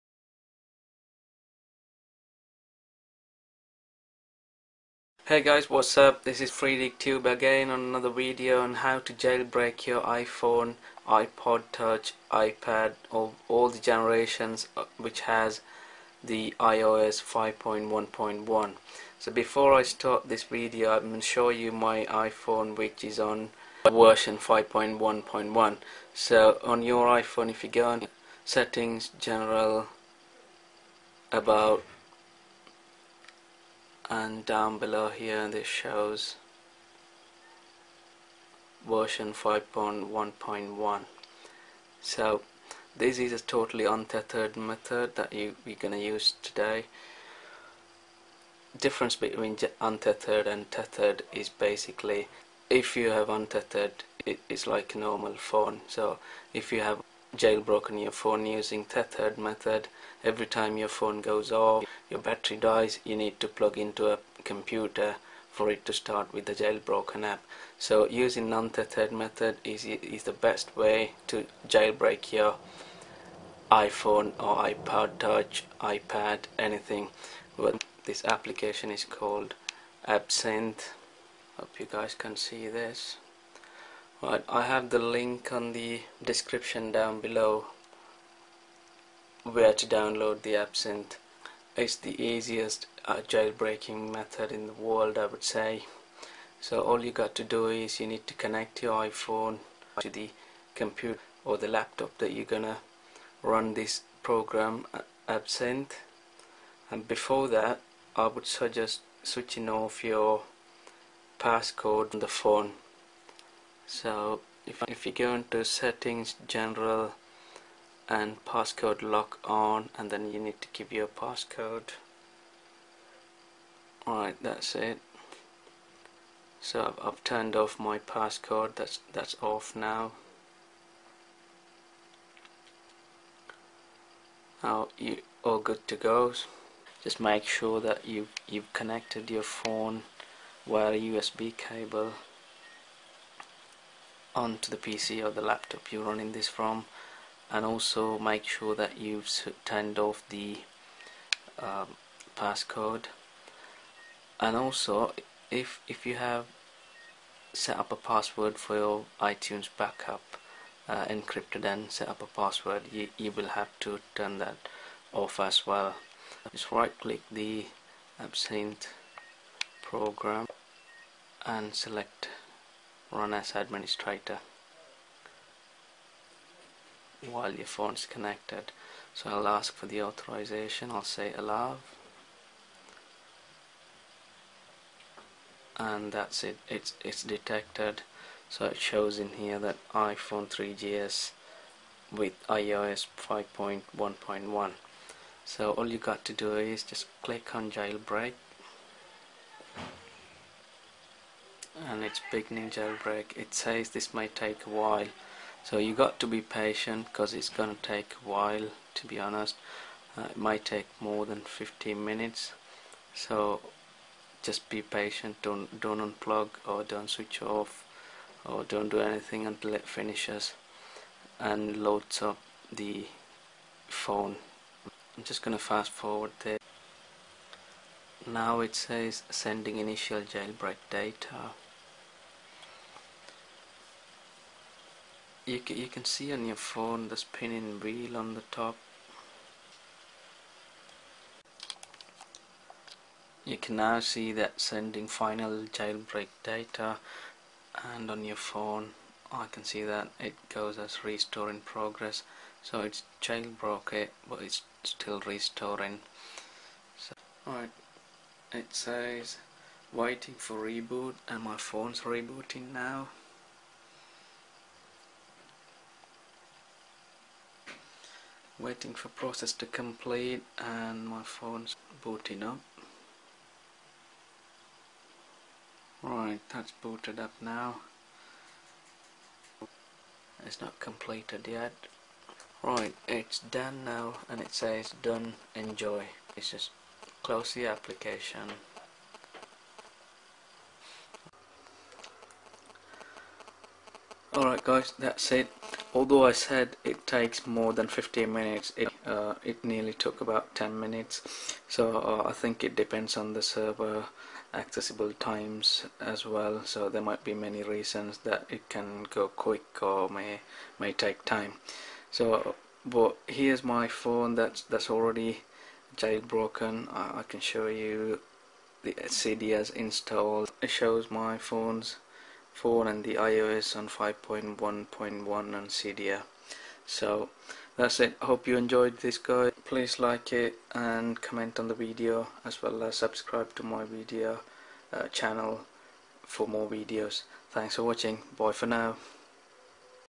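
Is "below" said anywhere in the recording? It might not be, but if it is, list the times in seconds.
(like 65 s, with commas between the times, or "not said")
34 s, 87 s.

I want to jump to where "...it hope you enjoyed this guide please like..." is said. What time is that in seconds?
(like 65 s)
327 s.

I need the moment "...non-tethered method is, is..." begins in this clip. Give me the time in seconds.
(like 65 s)
68 s.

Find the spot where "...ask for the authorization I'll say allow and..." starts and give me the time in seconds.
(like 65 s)
179 s.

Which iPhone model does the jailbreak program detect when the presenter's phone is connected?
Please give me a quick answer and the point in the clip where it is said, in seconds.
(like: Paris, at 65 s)
iPhone 3GS, at 189 s.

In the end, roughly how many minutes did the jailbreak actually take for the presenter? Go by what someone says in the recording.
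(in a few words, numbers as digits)
10.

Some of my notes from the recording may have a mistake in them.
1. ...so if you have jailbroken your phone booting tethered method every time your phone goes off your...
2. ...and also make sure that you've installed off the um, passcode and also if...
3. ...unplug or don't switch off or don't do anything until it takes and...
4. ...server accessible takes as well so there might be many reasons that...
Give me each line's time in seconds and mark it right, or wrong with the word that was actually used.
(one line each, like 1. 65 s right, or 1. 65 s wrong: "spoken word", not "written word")
1. 55 s wrong: "using", not "booting"
2. 147 s wrong: "turned", not "installed"
3. 215 s wrong: "finishes", not "takes"
4. 303 s wrong: "times", not "takes".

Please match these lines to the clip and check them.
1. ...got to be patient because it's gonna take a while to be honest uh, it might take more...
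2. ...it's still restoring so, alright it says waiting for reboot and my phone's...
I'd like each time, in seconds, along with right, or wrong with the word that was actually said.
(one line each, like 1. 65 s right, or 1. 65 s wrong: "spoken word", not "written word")
1. 205 s right
2. 254 s right.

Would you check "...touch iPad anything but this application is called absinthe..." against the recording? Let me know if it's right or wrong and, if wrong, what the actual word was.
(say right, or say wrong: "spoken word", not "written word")
right.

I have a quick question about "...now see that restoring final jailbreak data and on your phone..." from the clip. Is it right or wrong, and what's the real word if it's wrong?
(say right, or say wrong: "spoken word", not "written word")
wrong: "sending", not "restoring".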